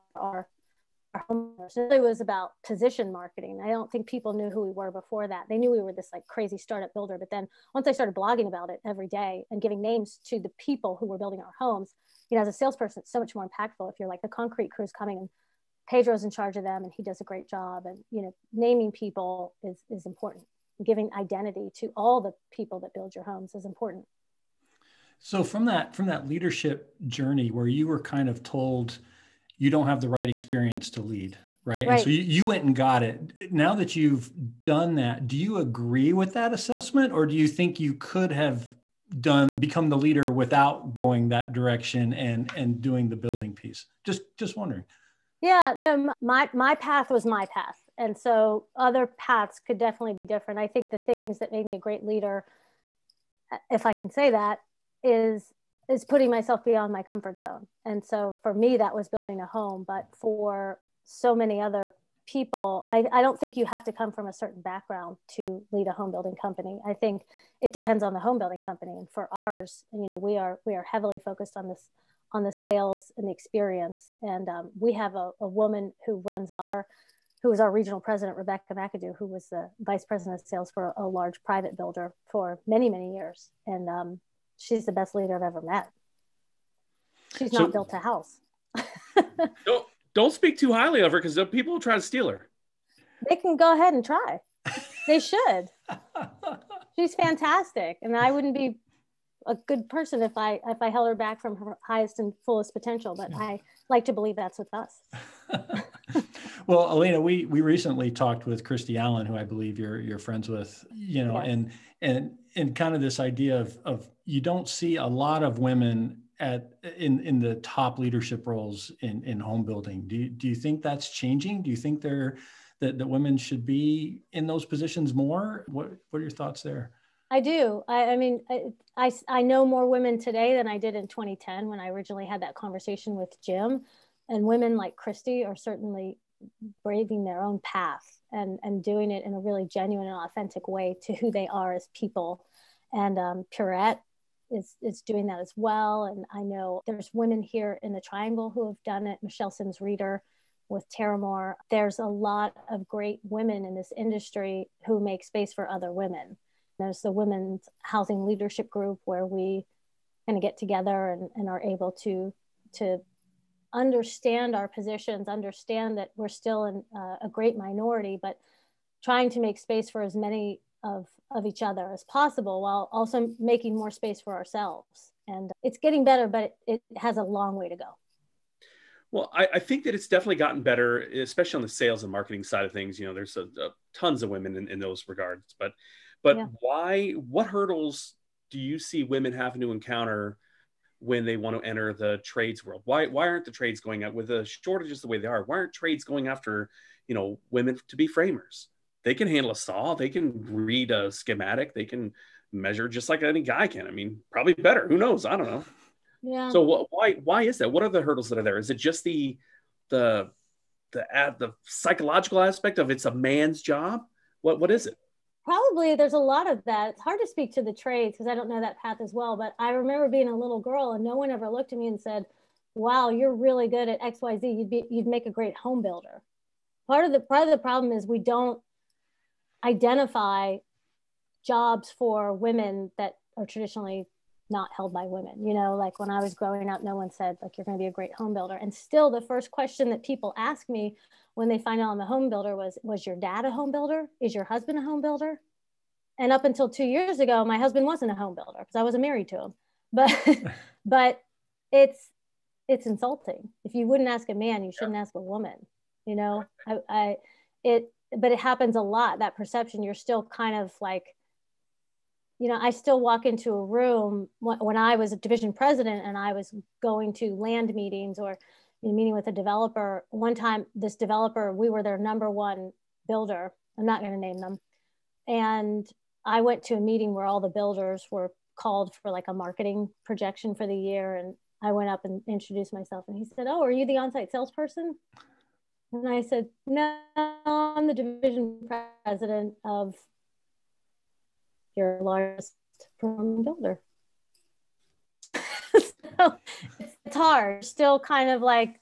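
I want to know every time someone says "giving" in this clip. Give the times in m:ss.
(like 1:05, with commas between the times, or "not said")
0:09, 0:20.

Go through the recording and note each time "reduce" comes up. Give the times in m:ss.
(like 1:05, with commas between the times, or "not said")
not said.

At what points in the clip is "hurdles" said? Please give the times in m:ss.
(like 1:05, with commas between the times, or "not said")
3:07, 3:28.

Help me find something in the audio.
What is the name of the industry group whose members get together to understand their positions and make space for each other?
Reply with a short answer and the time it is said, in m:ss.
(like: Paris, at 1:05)
Women's Housing Leadership Group, at 2:37.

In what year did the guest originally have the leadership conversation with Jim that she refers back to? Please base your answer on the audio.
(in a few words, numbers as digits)
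2010.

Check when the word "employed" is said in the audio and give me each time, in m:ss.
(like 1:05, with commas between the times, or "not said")
not said.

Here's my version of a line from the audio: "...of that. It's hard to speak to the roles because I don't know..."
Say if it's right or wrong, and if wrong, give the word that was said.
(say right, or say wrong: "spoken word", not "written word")
wrong: "trades", not "roles".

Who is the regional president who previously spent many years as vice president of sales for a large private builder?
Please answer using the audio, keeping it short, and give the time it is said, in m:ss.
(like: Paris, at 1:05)
Rebecca McAdoo, at 1:18.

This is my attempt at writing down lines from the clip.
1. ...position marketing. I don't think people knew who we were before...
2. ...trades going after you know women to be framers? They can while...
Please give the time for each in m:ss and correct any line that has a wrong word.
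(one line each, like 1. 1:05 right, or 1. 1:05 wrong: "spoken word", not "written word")
1. 0:02 right
2. 3:15 wrong: "handle", not "while".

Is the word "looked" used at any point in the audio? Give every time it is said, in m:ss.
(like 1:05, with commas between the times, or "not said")
3:41.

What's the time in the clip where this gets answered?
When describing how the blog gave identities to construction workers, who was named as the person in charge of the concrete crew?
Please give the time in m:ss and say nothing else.
0:15.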